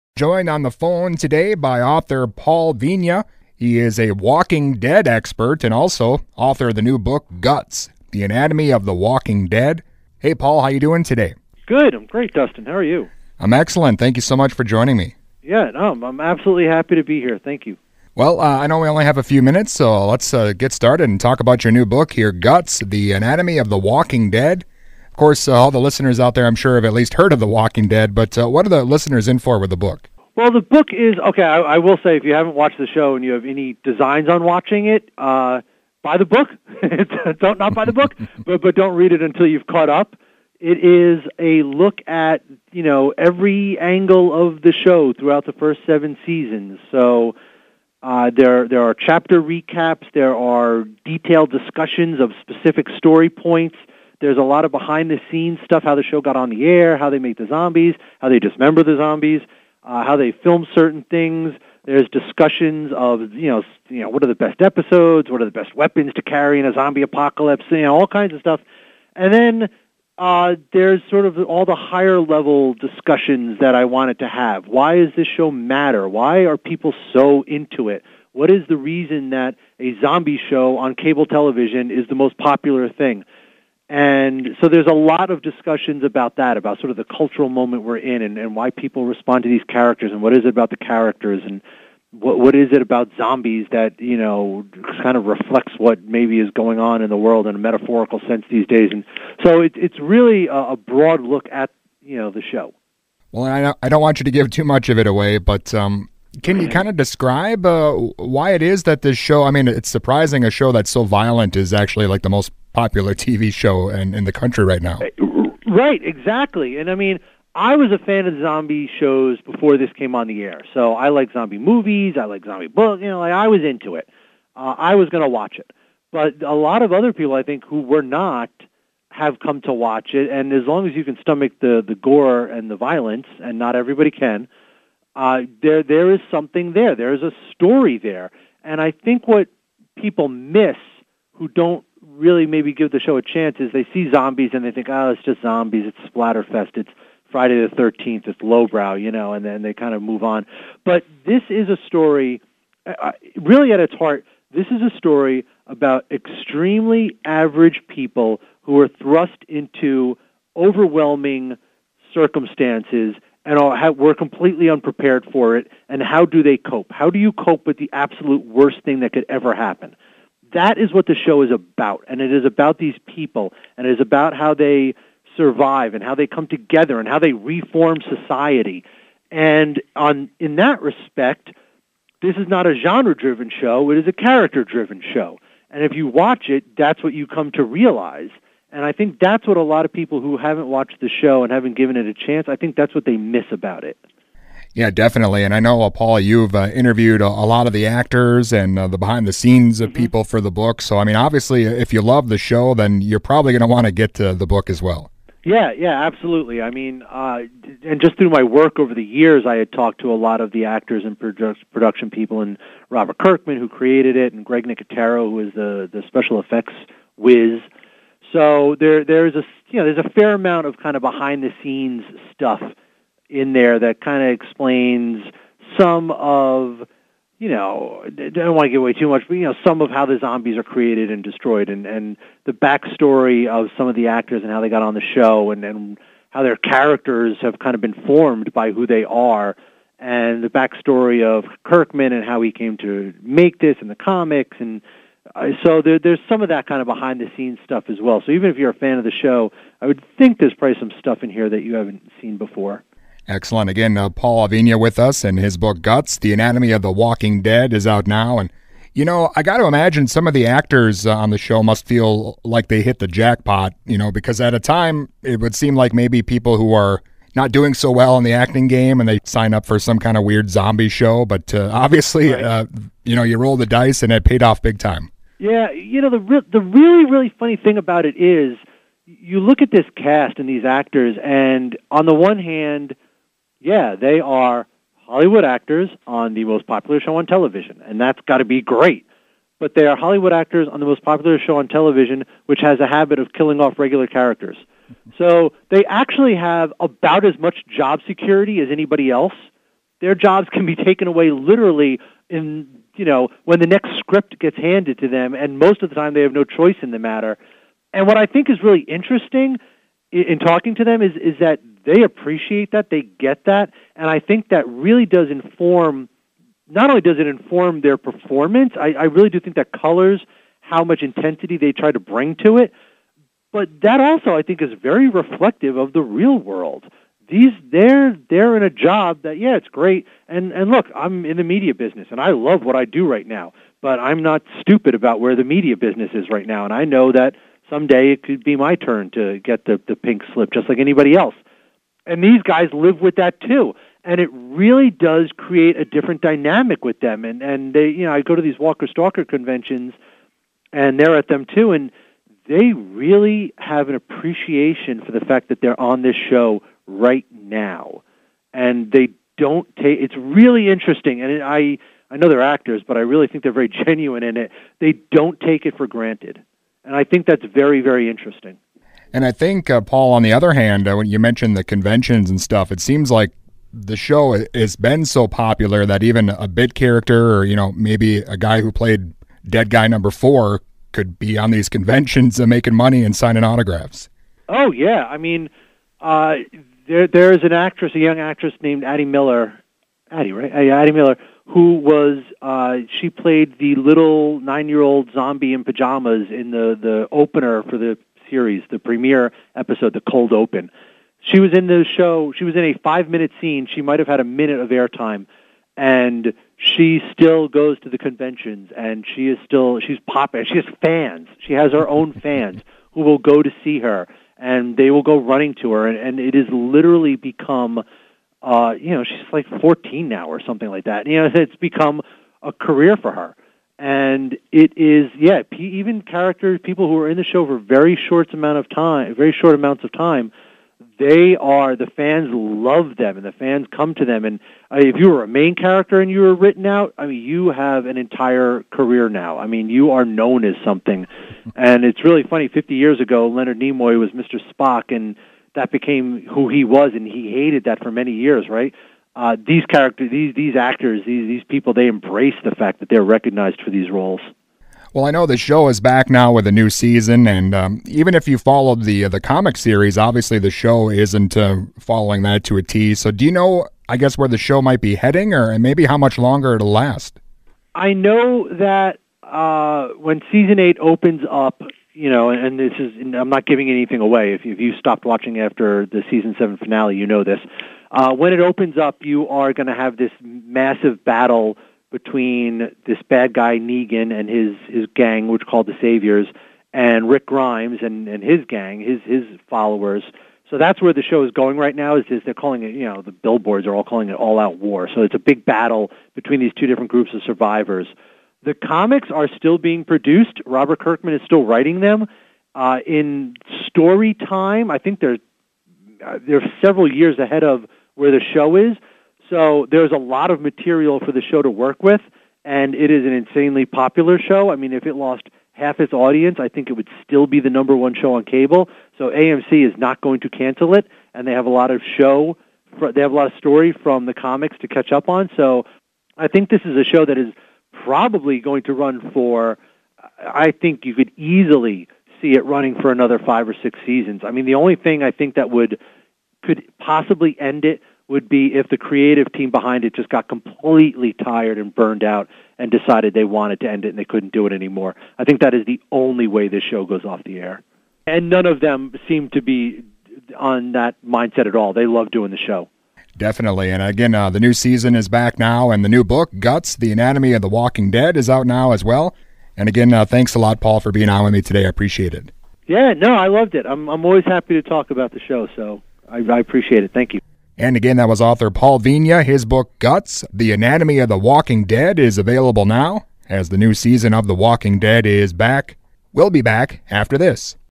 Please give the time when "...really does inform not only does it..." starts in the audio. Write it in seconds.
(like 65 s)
314 s.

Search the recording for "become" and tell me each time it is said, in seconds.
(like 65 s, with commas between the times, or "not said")
417 s, 421 s.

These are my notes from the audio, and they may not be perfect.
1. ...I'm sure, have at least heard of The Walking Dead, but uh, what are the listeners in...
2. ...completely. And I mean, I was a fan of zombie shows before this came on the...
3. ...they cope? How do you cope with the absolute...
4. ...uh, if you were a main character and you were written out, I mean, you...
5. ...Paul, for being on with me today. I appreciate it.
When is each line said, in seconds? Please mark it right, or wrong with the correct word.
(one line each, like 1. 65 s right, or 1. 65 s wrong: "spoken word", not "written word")
1. 26 s right
2. 116 s wrong: "exactly", not "completely"
3. 166 s right
4. 434 s right
5. 560 s right.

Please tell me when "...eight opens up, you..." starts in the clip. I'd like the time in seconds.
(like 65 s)
470 s.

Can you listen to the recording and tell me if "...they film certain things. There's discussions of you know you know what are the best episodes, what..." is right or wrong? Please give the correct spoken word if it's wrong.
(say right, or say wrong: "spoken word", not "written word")
right.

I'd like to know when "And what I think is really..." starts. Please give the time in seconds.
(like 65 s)
307 s.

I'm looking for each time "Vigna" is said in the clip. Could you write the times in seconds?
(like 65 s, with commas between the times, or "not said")
2 s, 254 s, 568 s.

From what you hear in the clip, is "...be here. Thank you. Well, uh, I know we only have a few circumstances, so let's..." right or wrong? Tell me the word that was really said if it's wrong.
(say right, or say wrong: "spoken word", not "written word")
wrong: "minutes", not "circumstances".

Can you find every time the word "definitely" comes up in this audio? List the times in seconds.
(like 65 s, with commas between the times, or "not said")
194 s, 553 s.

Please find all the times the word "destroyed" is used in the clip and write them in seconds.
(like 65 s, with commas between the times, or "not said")
231 s.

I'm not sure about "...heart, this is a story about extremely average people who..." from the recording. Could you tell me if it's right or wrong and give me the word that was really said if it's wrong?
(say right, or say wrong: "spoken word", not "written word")
right.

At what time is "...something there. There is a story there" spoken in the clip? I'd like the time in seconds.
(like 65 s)
136 s.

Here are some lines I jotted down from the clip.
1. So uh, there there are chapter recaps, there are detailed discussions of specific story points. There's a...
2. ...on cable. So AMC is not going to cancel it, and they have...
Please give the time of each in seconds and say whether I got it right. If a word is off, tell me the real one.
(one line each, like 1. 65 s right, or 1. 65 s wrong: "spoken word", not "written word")
1. 46 s right
2. 518 s right.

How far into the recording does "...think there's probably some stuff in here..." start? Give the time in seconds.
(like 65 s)
250 s.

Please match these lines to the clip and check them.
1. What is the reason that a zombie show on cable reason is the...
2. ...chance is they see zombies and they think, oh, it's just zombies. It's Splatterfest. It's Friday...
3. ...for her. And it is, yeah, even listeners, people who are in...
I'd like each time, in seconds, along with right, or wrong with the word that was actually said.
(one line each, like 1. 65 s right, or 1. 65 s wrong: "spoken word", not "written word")
1. 78 s wrong: "television", not "reason"
2. 143 s right
3. 422 s wrong: "characters", not "listeners".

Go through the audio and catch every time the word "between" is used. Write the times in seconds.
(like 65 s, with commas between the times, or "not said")
481 s, 496 s.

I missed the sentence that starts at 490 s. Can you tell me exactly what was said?
So that's where the show is going right now.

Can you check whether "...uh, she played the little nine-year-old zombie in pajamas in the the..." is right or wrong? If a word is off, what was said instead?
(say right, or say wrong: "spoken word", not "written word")
right.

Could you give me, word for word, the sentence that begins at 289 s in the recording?
But they are Hollywood actors on the most popular show on television, which has a habit of killing off regular characters.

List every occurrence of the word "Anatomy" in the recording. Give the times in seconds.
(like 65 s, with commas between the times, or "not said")
8 s, 23 s, 256 s, 556 s, 570 s.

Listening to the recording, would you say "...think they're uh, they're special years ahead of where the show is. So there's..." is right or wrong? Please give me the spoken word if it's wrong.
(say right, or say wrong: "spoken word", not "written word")
wrong: "several", not "special".